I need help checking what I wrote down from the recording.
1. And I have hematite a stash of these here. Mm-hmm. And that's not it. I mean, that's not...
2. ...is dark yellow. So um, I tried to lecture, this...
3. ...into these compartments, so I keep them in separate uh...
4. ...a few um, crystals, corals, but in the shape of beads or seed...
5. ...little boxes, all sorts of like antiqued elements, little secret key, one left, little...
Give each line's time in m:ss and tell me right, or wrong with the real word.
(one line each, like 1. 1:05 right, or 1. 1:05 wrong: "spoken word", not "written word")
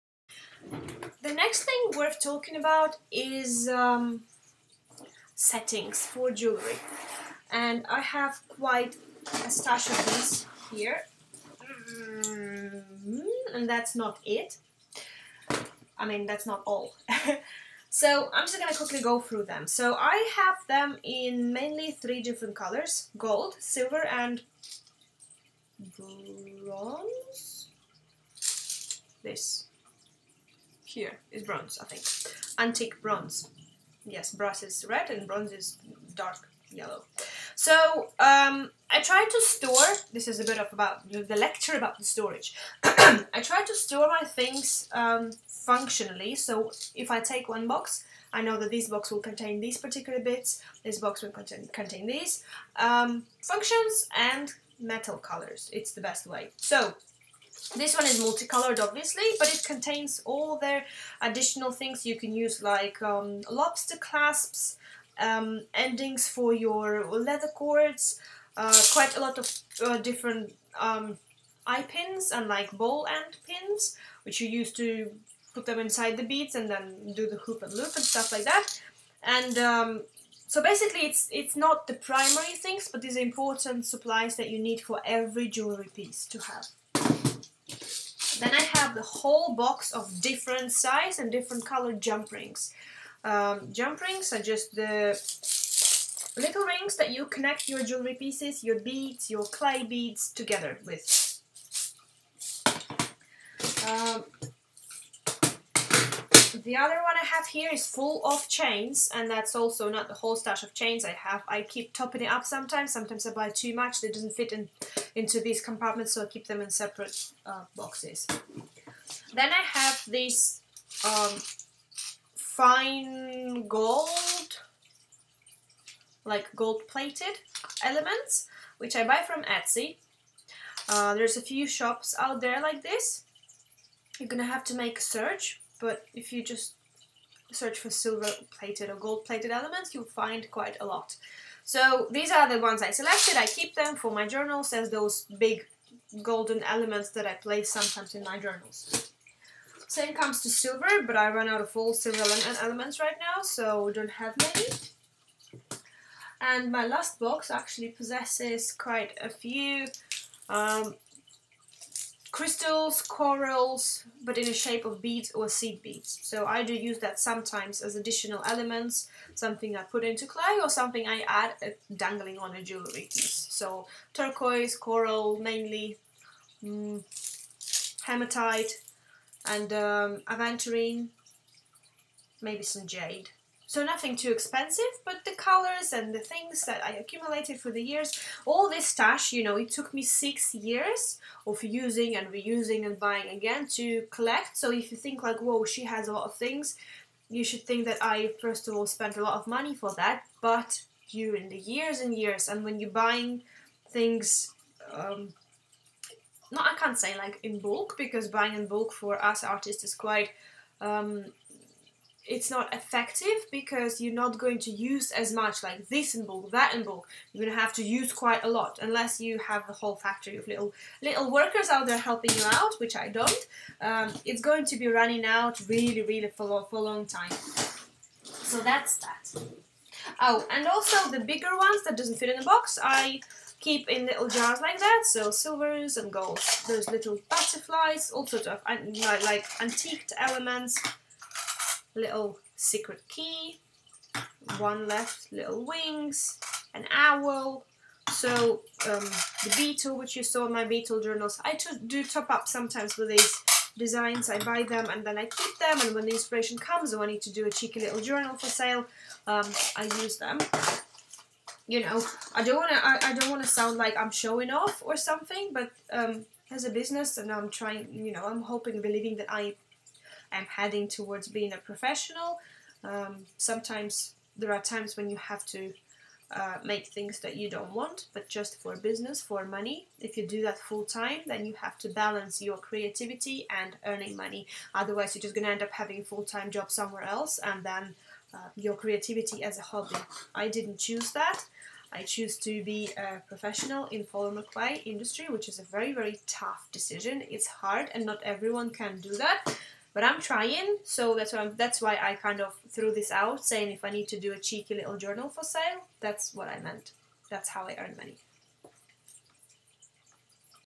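1. 0:07 wrong: "quite", not "hematite"
2. 0:35 wrong: "store", not "lecture"
3. 1:55 right
4. 2:39 right
5. 3:56 wrong: "butterflies", not "boxes".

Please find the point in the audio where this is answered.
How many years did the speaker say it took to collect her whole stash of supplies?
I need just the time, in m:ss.
3:10.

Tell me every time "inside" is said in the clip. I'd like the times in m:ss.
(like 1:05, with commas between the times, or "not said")
1:15.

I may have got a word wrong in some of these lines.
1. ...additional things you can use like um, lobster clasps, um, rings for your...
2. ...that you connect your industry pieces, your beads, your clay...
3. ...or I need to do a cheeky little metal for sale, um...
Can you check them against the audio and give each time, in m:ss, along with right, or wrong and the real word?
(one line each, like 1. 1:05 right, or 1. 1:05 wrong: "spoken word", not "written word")
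1. 1:01 wrong: "endings", not "rings"
2. 1:36 wrong: "jewelry", not "industry"
3. 4:16 wrong: "journal", not "metal".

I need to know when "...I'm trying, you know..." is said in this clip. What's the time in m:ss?
4:27.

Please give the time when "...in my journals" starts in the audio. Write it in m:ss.
2:28.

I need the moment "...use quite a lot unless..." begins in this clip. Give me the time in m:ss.
3:37.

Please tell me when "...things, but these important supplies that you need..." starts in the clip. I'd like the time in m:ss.
1:22.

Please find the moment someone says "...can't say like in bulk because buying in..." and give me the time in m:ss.
3:26.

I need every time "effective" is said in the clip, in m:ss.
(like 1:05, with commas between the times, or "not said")
3:32.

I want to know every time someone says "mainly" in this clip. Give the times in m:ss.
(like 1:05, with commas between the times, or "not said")
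0:21, 2:55.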